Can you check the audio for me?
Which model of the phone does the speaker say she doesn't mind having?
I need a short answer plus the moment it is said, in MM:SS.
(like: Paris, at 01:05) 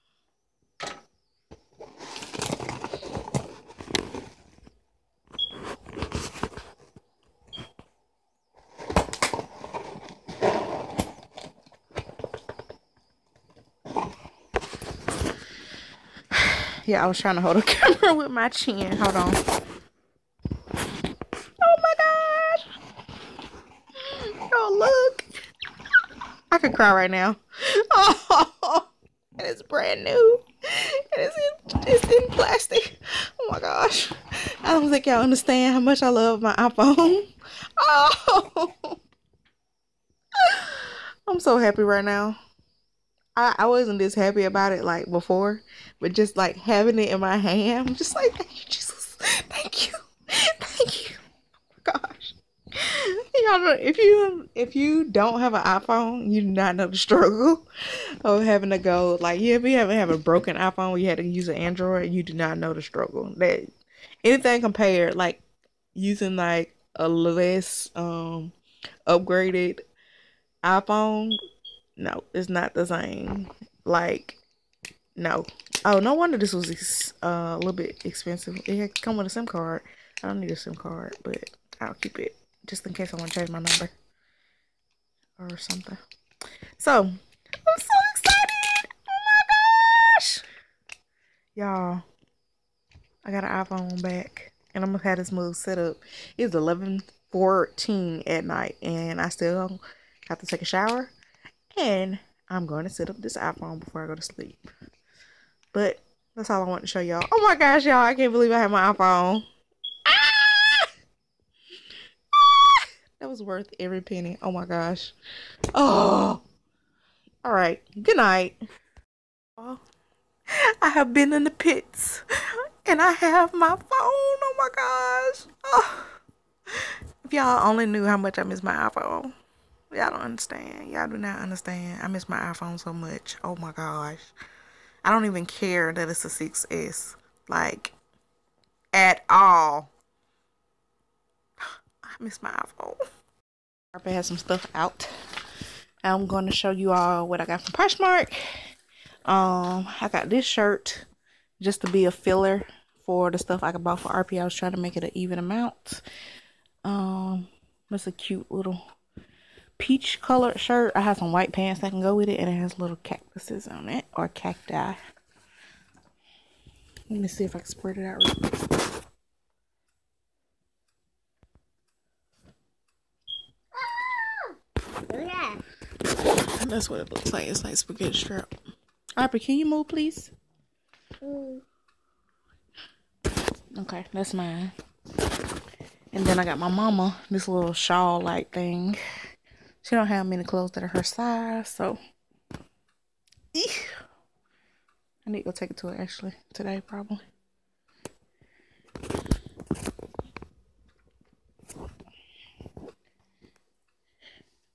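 6S, at 02:16.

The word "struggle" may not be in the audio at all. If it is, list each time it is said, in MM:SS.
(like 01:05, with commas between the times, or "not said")
00:56, 01:02.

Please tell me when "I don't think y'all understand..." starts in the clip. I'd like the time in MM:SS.
00:34.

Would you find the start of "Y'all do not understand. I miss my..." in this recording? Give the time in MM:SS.
02:10.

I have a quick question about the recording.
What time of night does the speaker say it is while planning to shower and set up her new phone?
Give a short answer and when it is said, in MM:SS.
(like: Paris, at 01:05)
11:14, at 01:36.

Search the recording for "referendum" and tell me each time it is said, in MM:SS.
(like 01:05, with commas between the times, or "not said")
not said.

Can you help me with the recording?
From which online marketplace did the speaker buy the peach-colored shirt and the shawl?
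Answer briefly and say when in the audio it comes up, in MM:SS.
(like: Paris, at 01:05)
Poshmark, at 02:27.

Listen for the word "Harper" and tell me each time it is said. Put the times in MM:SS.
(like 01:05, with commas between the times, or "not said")
02:59.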